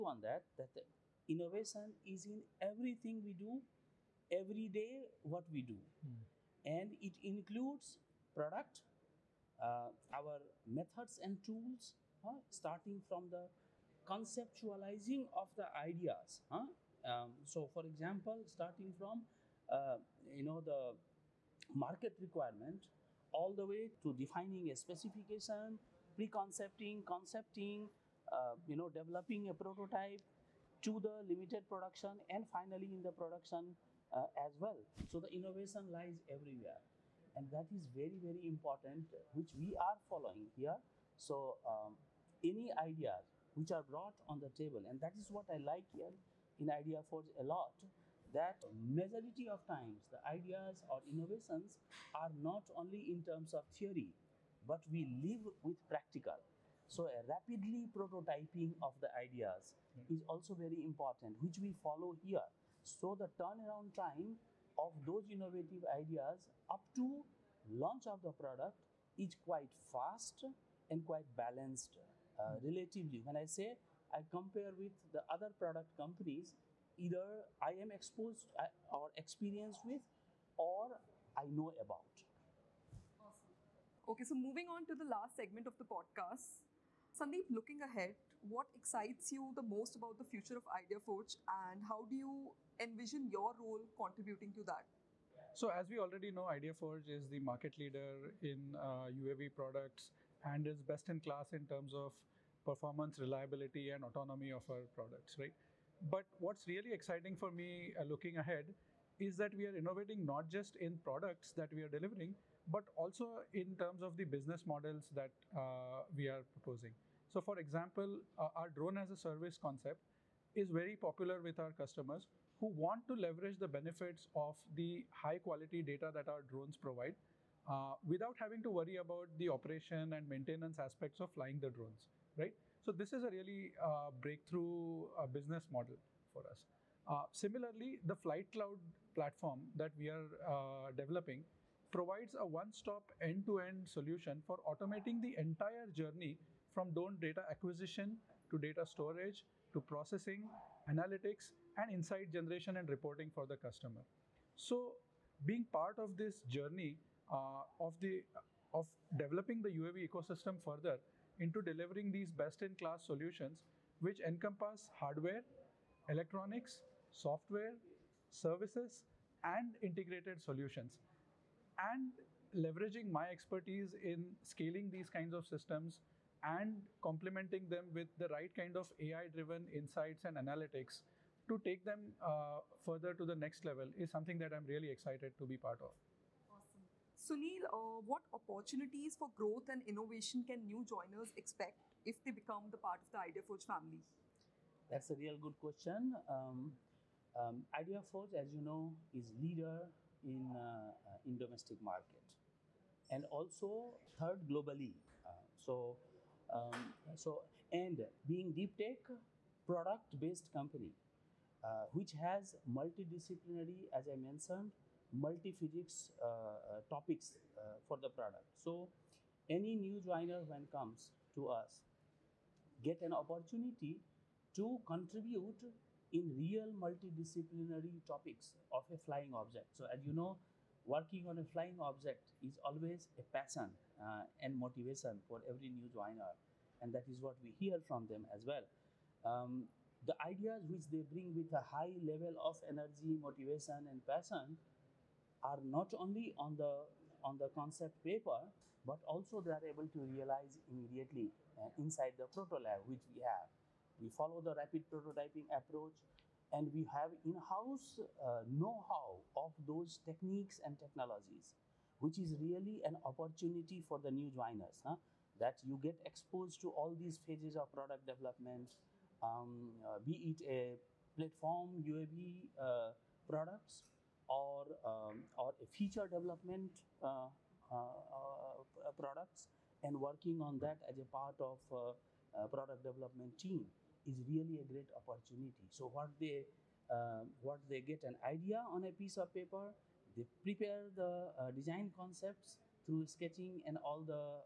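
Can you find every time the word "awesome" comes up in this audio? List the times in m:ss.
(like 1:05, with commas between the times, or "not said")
1:22, 3:06.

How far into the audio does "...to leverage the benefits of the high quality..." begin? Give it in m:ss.
2:03.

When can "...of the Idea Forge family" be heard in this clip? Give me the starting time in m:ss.
3:13.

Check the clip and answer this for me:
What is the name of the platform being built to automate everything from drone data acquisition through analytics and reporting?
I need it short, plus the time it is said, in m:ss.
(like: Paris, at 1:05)
Flight Cloud, at 2:18.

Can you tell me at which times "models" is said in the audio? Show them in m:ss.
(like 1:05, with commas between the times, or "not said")
1:54, 2:15.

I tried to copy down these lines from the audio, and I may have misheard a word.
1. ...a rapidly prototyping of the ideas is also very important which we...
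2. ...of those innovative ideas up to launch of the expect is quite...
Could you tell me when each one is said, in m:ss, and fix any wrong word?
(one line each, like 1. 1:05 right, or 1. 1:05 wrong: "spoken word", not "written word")
1. 0:57 right
2. 1:04 wrong: "product", not "expect".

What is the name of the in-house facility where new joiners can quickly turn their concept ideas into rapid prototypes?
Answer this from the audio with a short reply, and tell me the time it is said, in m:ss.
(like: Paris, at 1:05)
Protolab, at 4:12.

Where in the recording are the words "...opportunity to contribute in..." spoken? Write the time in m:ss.
3:43.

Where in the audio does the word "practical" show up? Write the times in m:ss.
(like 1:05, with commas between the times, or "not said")
0:55.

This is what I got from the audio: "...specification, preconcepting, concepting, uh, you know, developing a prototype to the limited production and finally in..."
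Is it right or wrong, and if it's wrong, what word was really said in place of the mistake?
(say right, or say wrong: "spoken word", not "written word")
right.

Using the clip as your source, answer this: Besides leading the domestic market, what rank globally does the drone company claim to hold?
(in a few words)
Third.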